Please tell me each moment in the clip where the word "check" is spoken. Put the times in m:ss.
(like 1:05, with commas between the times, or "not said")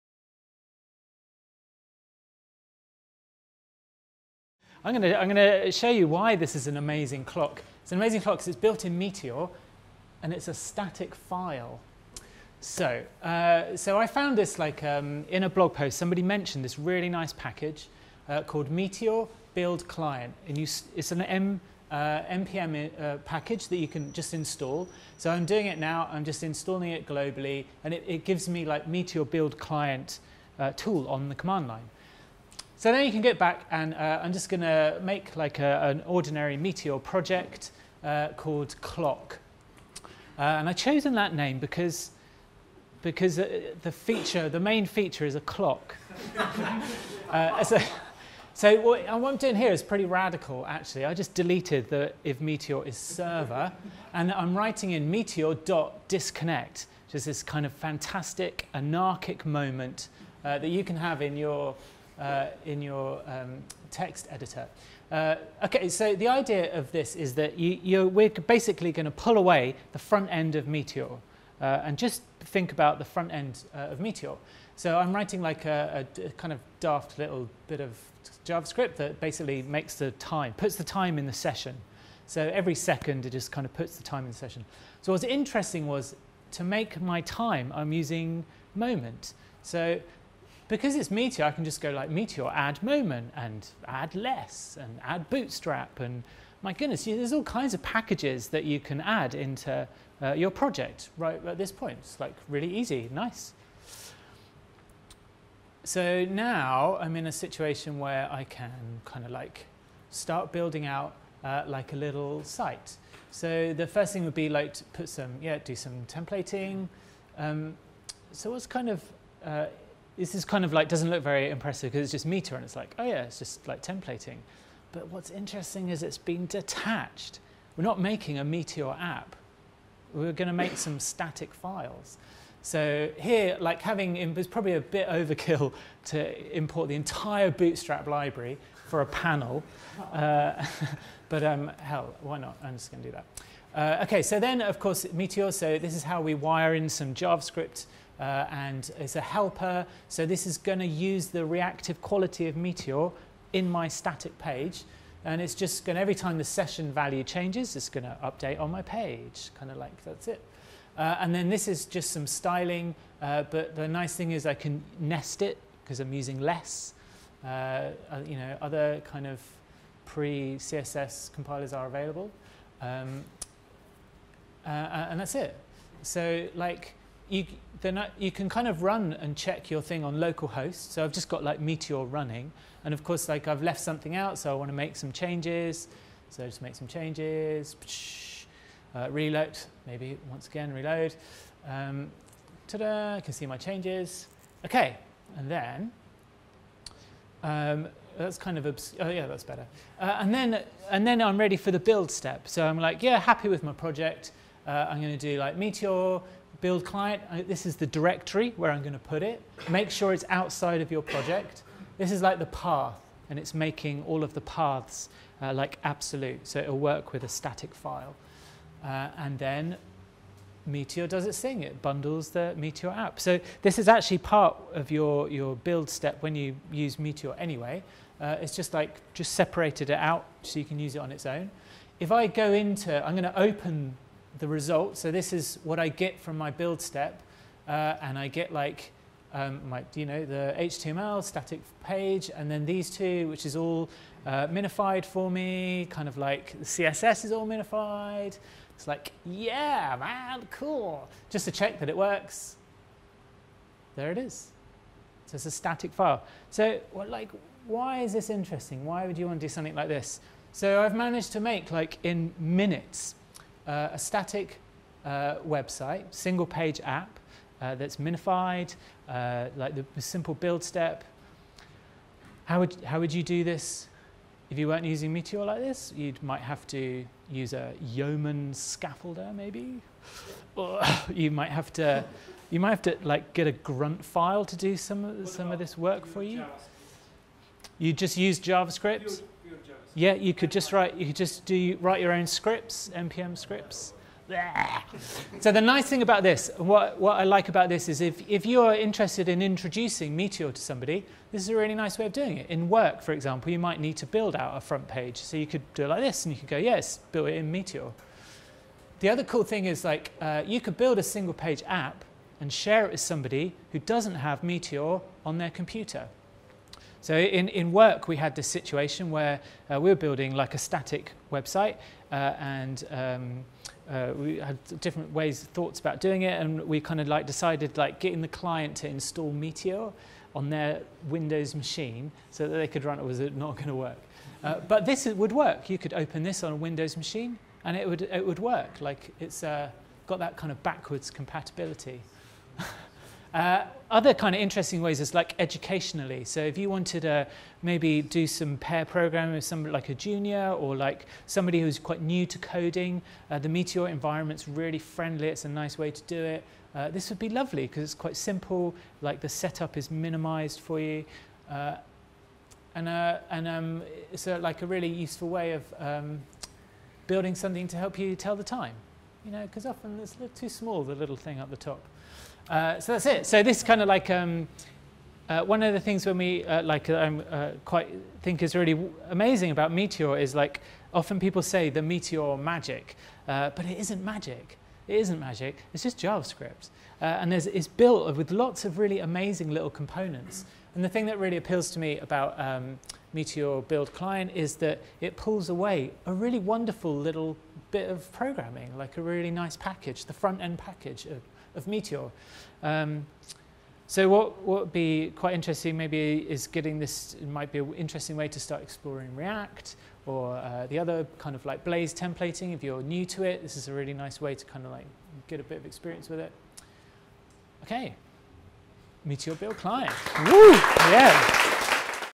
2:59, 4:11.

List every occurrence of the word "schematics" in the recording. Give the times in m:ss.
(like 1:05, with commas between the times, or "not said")
not said.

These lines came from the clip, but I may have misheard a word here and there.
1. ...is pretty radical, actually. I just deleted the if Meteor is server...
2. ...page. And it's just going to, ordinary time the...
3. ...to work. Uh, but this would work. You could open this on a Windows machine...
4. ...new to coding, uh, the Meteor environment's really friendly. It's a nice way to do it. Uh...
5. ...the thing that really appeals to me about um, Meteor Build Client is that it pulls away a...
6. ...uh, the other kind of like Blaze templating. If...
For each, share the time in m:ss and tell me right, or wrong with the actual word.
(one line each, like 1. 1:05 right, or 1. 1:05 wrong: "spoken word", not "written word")
1. 0:49 right
2. 2:34 wrong: "every", not "ordinary"
3. 5:33 right
4. 5:52 right
5. 6:30 right
6. 6:50 right.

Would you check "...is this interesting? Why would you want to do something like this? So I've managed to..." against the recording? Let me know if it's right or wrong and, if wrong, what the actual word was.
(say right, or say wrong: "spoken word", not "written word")
right.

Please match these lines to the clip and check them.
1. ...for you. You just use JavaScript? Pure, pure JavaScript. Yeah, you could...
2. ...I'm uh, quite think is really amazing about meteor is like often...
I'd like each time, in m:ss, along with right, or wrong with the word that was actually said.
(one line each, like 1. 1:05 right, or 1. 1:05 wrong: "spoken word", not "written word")
1. 4:46 right
2. 6:16 right.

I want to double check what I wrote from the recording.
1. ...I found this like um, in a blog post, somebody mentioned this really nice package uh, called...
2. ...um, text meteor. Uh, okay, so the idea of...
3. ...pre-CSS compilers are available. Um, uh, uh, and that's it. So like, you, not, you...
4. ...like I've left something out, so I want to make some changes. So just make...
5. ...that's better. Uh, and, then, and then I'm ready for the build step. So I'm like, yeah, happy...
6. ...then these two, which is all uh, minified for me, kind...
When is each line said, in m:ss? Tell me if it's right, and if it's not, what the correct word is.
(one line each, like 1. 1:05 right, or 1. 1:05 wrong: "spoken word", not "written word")
1. 0:13 right
2. 1:03 wrong: "editor", not "meteor"
3. 2:50 right
4. 3:03 right
5. 3:19 right
6. 4:02 right.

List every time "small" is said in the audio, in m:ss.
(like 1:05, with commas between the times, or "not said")
6:10.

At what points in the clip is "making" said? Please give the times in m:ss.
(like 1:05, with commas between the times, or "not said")
2:07, 3:33.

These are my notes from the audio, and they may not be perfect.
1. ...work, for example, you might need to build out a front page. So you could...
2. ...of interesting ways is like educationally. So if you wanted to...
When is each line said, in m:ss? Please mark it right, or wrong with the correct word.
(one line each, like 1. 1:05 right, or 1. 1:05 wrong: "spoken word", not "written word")
1. 5:02 right
2. 5:44 right.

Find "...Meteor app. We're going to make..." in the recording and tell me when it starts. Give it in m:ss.
2:08.